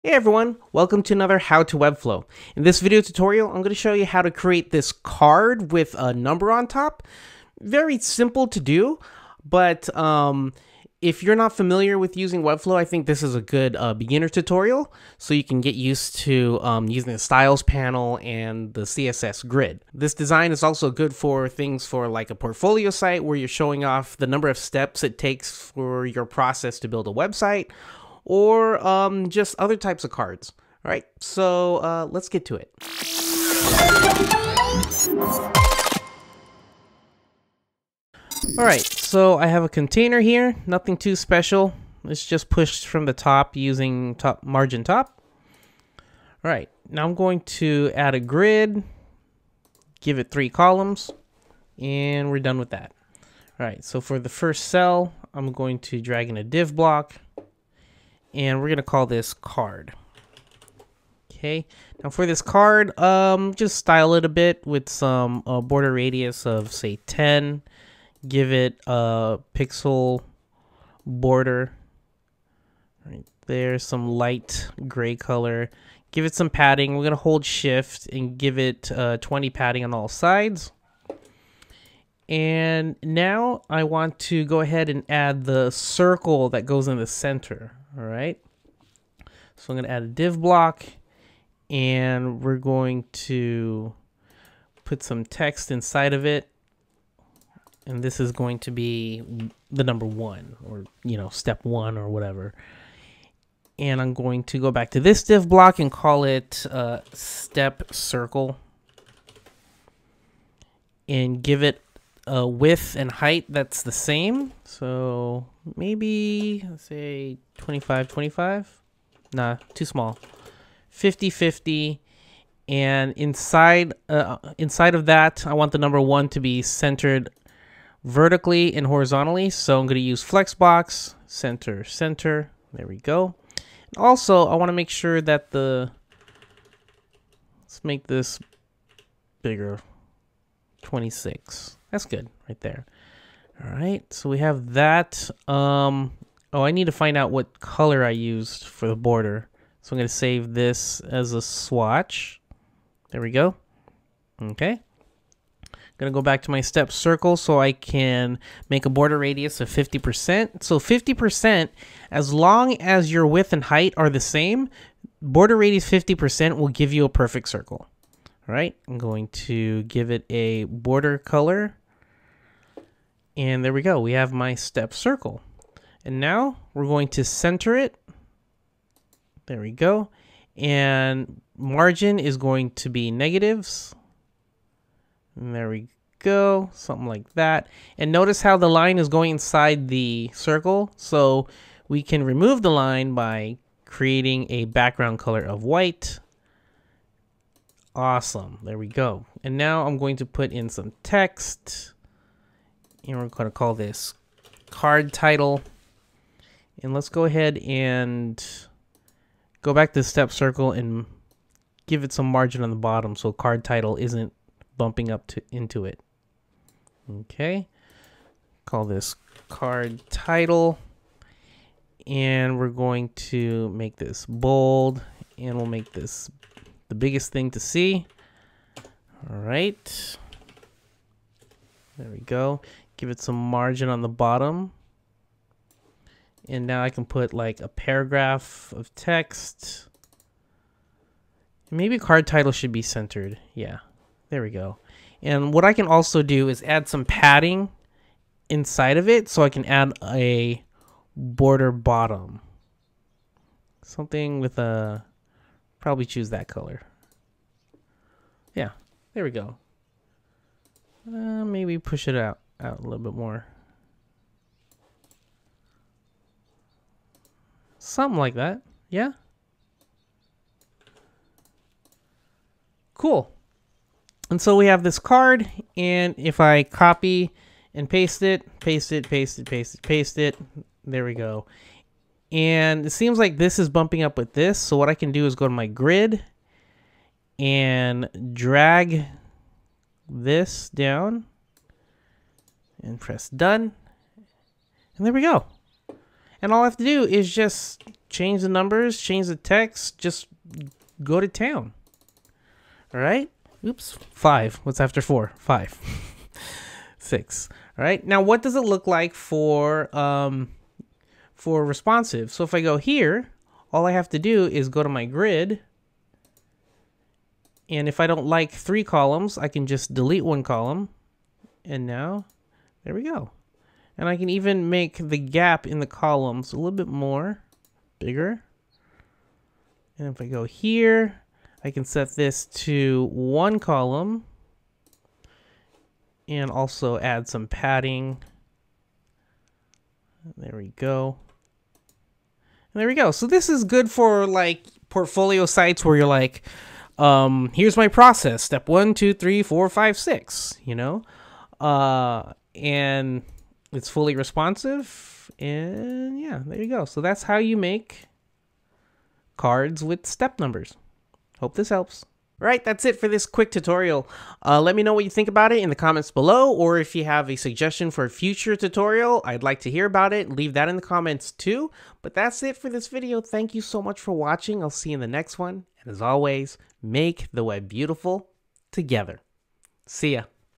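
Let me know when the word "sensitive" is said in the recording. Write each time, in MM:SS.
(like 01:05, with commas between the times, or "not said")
not said.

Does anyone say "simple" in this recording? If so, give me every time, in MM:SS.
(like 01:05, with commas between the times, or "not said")
00:07.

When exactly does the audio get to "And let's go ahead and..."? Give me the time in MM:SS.
03:26.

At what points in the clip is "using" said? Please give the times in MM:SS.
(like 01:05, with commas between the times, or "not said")
00:12, 00:16, 00:43.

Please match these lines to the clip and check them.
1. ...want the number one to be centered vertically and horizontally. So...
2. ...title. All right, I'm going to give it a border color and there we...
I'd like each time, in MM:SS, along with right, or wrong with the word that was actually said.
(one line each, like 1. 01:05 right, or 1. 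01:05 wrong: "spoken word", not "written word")
1. 02:05 right
2. 02:47 wrong: "circle", not "title".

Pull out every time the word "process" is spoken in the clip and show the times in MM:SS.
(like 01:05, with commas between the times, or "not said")
00:26, 05:47.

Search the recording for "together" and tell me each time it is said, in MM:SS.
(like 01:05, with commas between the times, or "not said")
06:18.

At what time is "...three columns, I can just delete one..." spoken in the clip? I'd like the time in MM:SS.
05:18.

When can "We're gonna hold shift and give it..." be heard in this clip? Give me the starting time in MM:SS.
01:16.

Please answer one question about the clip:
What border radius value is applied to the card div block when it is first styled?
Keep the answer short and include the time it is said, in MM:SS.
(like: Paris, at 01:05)
10, at 01:07.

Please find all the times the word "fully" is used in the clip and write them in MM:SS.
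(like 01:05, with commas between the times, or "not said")
05:53.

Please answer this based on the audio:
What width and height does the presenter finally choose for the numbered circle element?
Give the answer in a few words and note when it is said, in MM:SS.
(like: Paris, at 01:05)
50, at 02:00.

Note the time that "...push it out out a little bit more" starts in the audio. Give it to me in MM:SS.
04:21.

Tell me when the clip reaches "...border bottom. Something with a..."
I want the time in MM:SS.
04:11.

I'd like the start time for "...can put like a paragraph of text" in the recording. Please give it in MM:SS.
03:56.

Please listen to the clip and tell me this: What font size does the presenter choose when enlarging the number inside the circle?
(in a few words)
26.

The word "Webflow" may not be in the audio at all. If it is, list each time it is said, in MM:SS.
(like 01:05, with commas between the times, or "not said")
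00:01, 00:12.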